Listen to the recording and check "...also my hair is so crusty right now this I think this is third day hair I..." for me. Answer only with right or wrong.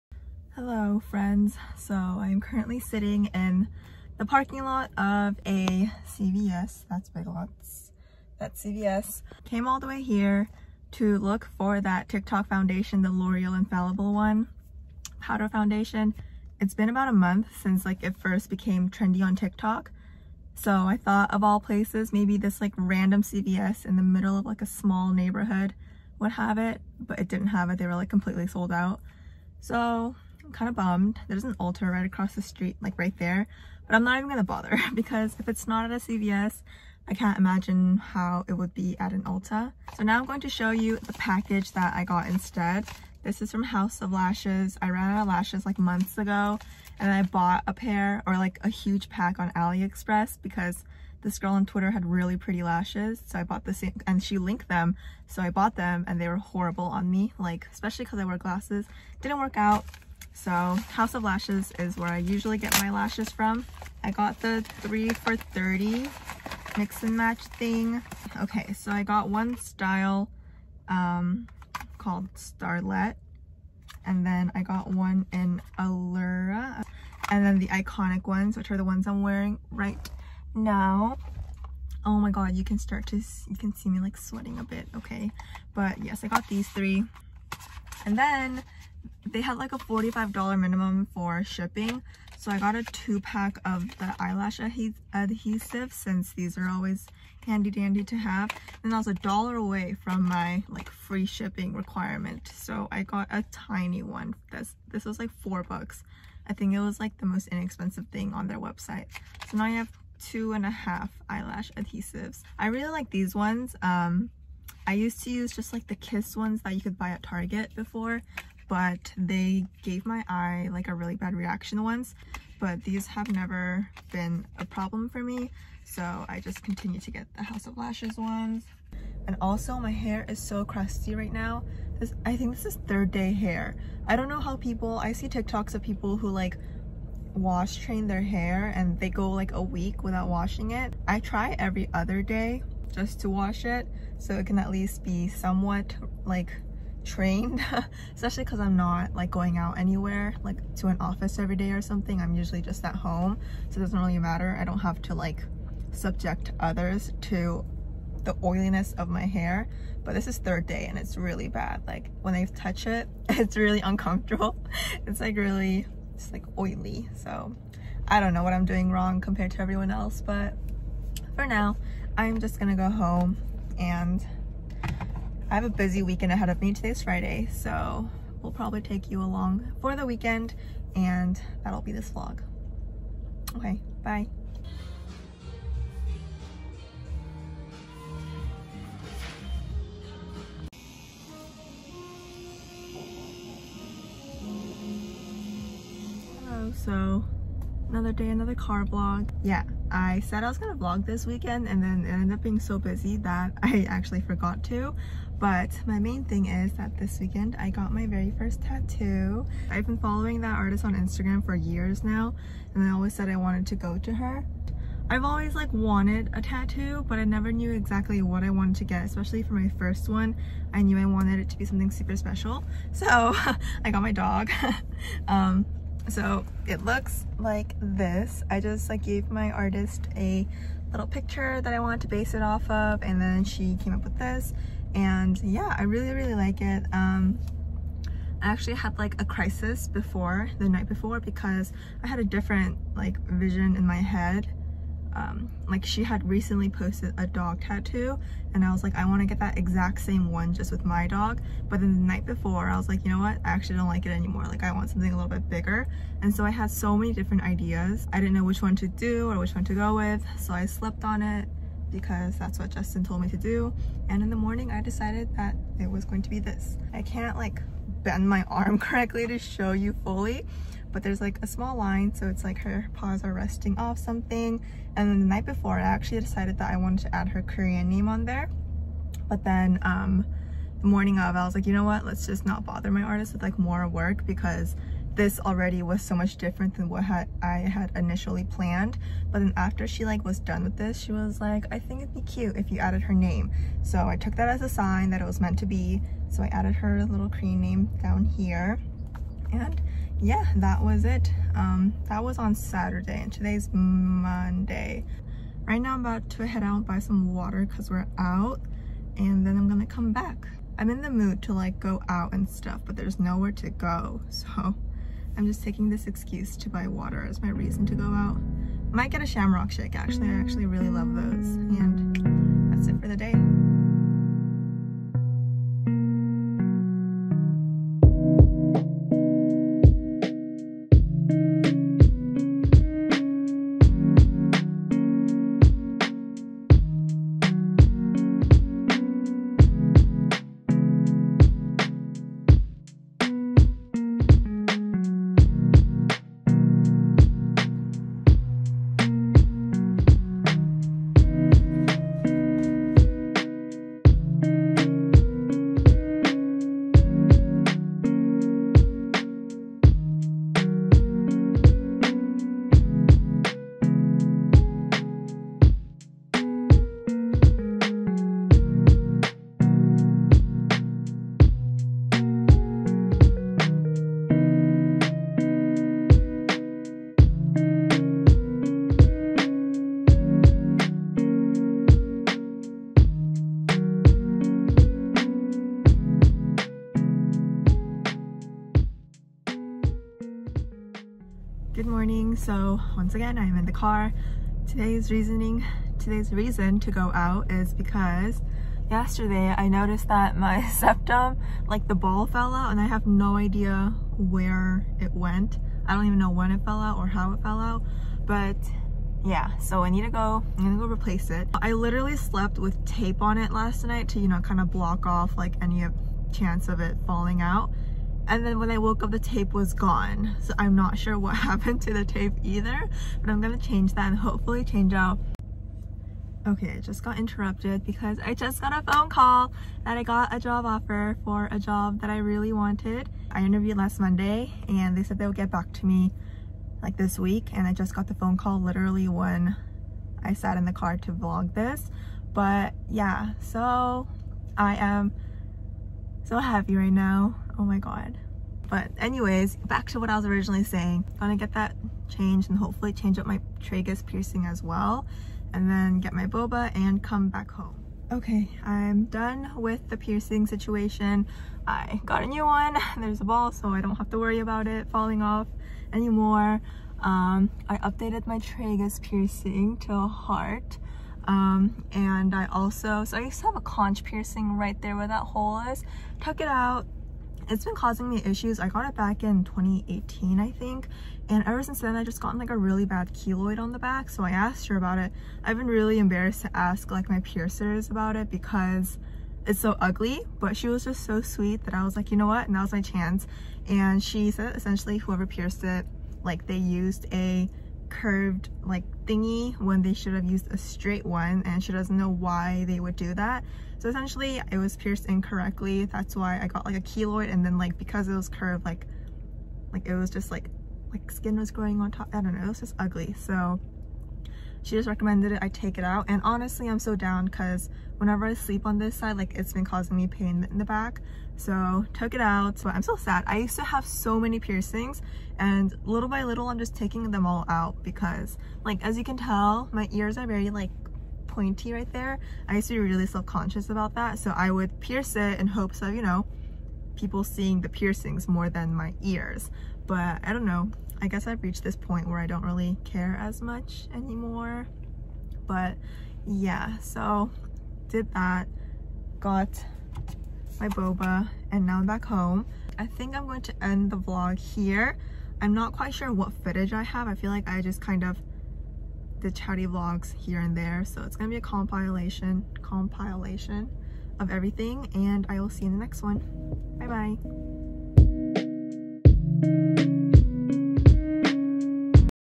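right.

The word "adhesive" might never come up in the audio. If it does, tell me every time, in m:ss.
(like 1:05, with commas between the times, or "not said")
1:35, 1:51.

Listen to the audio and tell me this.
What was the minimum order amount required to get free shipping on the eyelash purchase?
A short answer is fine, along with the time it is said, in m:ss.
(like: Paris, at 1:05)
$45, at 1:29.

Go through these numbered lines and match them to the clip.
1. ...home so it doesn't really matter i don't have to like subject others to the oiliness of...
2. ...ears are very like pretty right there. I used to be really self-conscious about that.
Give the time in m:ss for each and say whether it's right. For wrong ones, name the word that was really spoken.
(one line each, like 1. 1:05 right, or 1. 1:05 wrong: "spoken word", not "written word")
1. 2:32 right
2. 8:49 wrong: "pointy", not "pretty".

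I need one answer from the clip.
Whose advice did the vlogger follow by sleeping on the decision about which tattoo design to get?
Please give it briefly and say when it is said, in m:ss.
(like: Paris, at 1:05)
Justin, at 4:22.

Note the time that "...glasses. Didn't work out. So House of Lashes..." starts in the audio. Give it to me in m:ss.
0:58.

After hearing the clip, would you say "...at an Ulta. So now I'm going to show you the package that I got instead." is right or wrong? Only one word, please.
right.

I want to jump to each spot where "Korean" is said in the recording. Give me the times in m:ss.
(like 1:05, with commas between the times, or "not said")
4:37, 4:57.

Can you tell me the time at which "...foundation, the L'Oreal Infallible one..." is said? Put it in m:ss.
0:12.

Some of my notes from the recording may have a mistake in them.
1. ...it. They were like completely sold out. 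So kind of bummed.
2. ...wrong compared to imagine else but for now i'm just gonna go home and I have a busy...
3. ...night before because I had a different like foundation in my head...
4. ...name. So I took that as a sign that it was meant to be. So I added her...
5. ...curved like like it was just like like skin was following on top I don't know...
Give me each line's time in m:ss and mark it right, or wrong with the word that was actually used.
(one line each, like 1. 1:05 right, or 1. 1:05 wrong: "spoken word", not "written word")
1. 0:27 right
2. 2:48 wrong: "everyone", not "imagine"
3. 4:00 wrong: "vision", not "foundation"
4. 4:53 right
5. 8:28 wrong: "growing", not "following".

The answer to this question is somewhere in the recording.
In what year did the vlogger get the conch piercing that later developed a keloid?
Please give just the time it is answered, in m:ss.
7:59.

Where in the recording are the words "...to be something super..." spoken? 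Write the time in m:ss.
3:41.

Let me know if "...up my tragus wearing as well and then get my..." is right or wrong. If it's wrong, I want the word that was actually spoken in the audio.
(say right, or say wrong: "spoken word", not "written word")
wrong: "piercing", not "wearing".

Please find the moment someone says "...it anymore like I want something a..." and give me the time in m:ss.
4:14.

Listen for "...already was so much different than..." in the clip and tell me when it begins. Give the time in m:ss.
4:45.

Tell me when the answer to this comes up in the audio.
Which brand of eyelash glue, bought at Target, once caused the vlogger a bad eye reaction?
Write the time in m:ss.
1:55.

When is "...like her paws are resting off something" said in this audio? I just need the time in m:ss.
4:32.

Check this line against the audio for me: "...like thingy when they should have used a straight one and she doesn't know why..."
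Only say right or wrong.
right.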